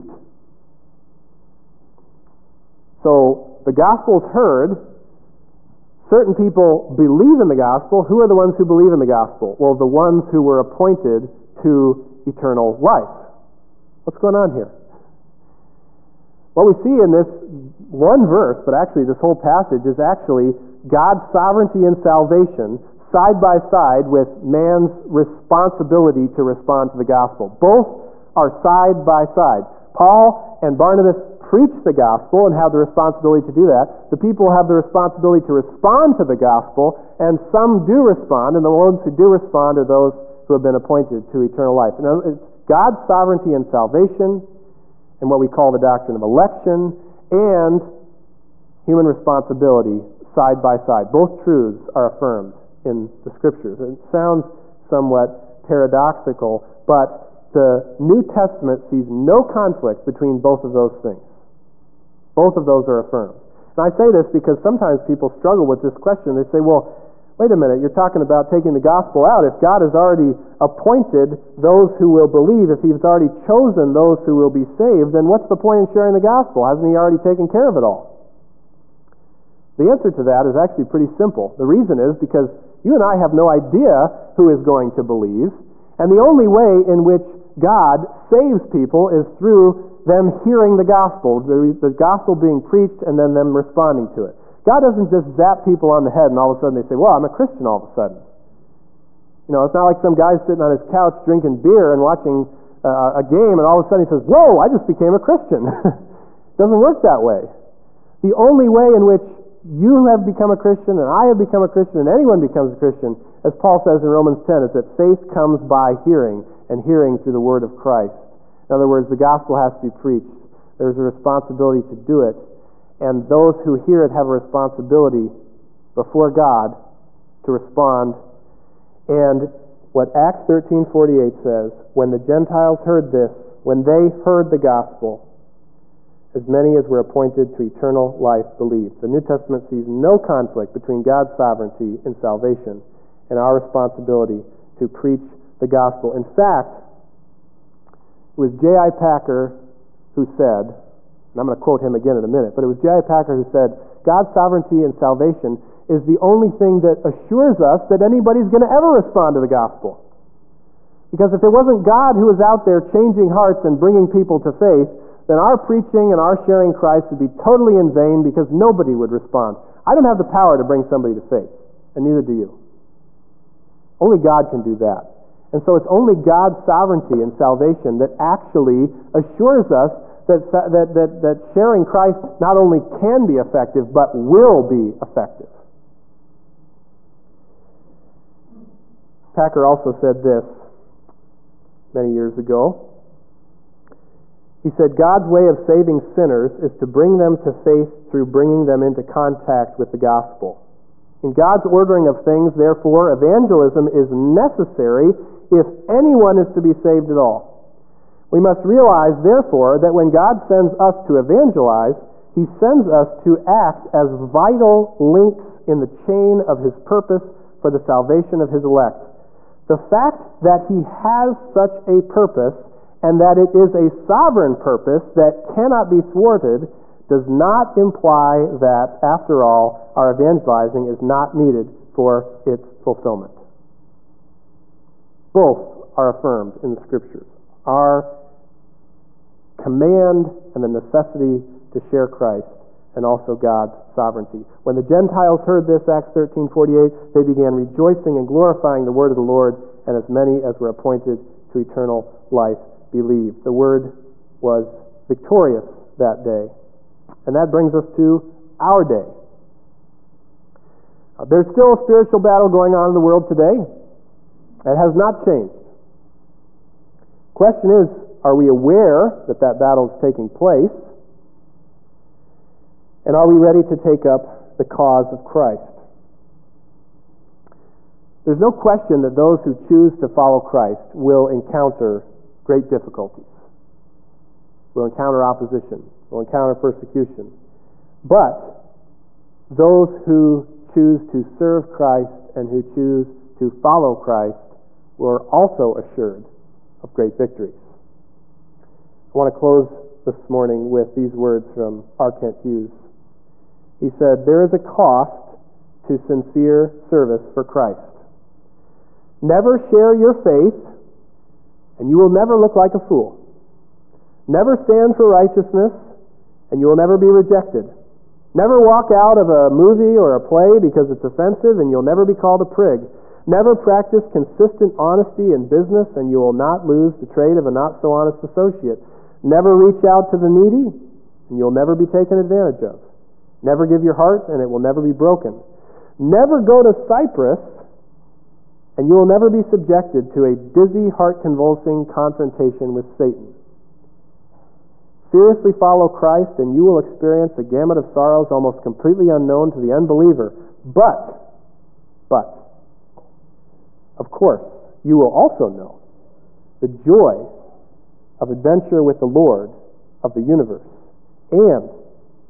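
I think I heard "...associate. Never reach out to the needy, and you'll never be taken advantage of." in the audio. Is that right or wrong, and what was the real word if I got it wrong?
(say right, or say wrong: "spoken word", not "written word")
right.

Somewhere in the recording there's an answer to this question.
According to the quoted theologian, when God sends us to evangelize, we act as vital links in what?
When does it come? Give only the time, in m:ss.
3:35.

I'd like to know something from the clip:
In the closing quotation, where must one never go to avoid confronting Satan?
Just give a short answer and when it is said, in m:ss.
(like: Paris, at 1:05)
Cyprus, at 5:36.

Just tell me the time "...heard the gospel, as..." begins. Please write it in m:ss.
2:14.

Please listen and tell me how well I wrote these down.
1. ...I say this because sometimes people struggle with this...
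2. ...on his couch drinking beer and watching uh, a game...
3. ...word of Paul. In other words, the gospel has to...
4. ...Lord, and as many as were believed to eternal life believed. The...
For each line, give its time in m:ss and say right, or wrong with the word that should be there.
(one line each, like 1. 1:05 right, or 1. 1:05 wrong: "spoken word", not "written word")
1. 1:03 right
2. 1:40 right
3. 1:57 wrong: "Christ", not "Paul"
4. 4:09 wrong: "appointed", not "believed".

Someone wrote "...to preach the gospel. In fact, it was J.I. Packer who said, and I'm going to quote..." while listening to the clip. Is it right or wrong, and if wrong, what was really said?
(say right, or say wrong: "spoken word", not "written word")
right.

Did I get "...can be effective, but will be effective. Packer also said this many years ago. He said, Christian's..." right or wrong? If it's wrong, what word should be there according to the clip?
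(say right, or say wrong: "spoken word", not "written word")
wrong: "God", not "Christian".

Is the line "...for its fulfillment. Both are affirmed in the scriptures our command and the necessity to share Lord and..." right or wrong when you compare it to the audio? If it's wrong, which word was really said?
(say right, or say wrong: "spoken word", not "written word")
wrong: "Christ", not "Lord".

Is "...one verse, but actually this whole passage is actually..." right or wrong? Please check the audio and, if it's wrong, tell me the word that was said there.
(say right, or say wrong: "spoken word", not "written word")
right.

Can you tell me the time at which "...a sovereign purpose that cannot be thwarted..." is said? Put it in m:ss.
3:43.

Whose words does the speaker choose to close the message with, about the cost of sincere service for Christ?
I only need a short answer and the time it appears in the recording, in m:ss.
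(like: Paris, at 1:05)
R. Kent Hughes, at 5:01.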